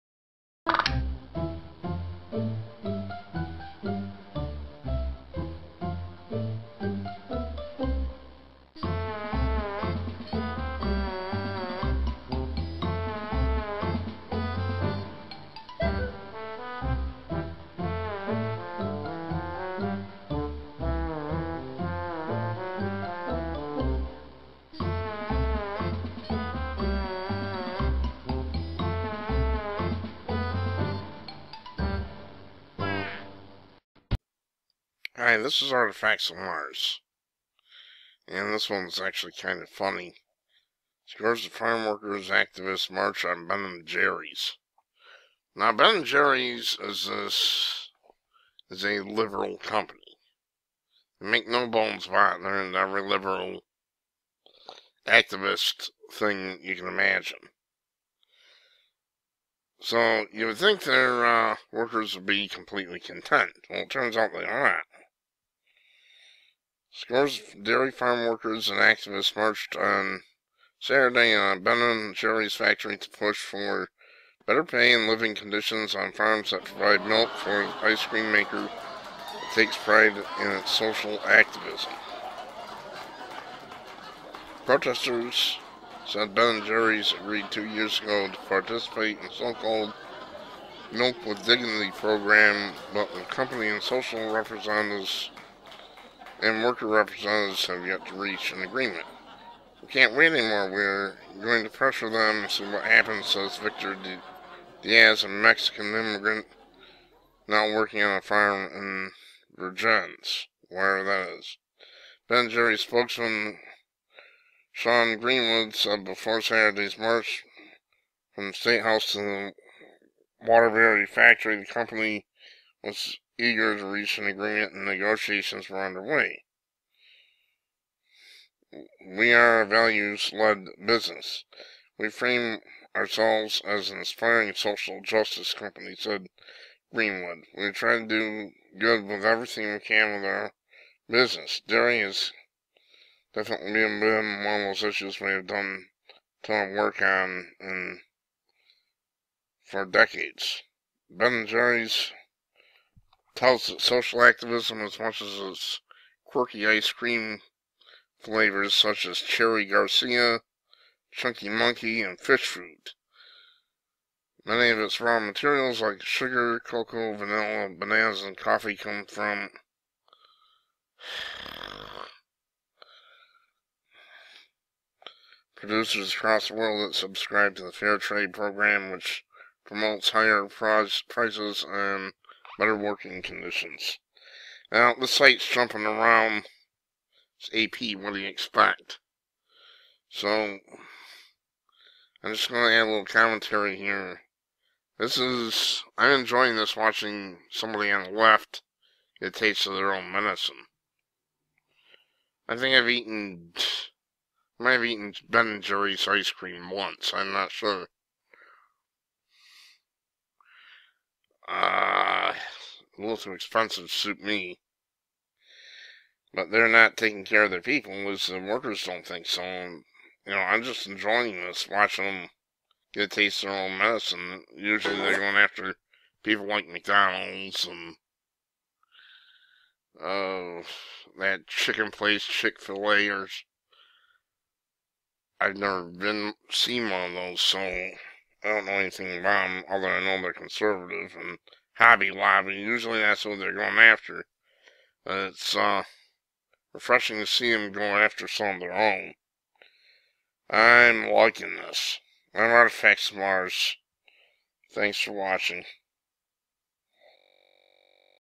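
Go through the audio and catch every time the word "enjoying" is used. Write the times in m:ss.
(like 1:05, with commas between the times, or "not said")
3:16, 3:40.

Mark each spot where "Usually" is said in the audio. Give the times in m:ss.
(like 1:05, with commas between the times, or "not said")
3:44, 4:02.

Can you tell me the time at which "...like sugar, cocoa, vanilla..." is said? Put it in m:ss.
2:45.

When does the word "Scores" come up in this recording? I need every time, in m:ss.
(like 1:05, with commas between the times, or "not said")
0:41, 1:06.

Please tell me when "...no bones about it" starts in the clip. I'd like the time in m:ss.
0:51.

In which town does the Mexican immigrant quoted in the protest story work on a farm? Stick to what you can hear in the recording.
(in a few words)
Vergennes.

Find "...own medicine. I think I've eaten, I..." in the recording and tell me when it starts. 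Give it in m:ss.
3:19.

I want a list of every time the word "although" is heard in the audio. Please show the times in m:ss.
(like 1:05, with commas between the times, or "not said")
3:59.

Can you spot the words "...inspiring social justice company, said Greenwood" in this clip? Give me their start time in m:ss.
2:13.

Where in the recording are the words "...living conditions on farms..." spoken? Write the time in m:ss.
1:15.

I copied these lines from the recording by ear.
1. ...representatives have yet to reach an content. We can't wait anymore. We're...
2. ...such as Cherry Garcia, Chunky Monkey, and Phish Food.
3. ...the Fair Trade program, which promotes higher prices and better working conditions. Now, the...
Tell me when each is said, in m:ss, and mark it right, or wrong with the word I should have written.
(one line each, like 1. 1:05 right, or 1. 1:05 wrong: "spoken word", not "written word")
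1. 1:36 wrong: "agreement", not "content"
2. 2:38 right
3. 2:57 right.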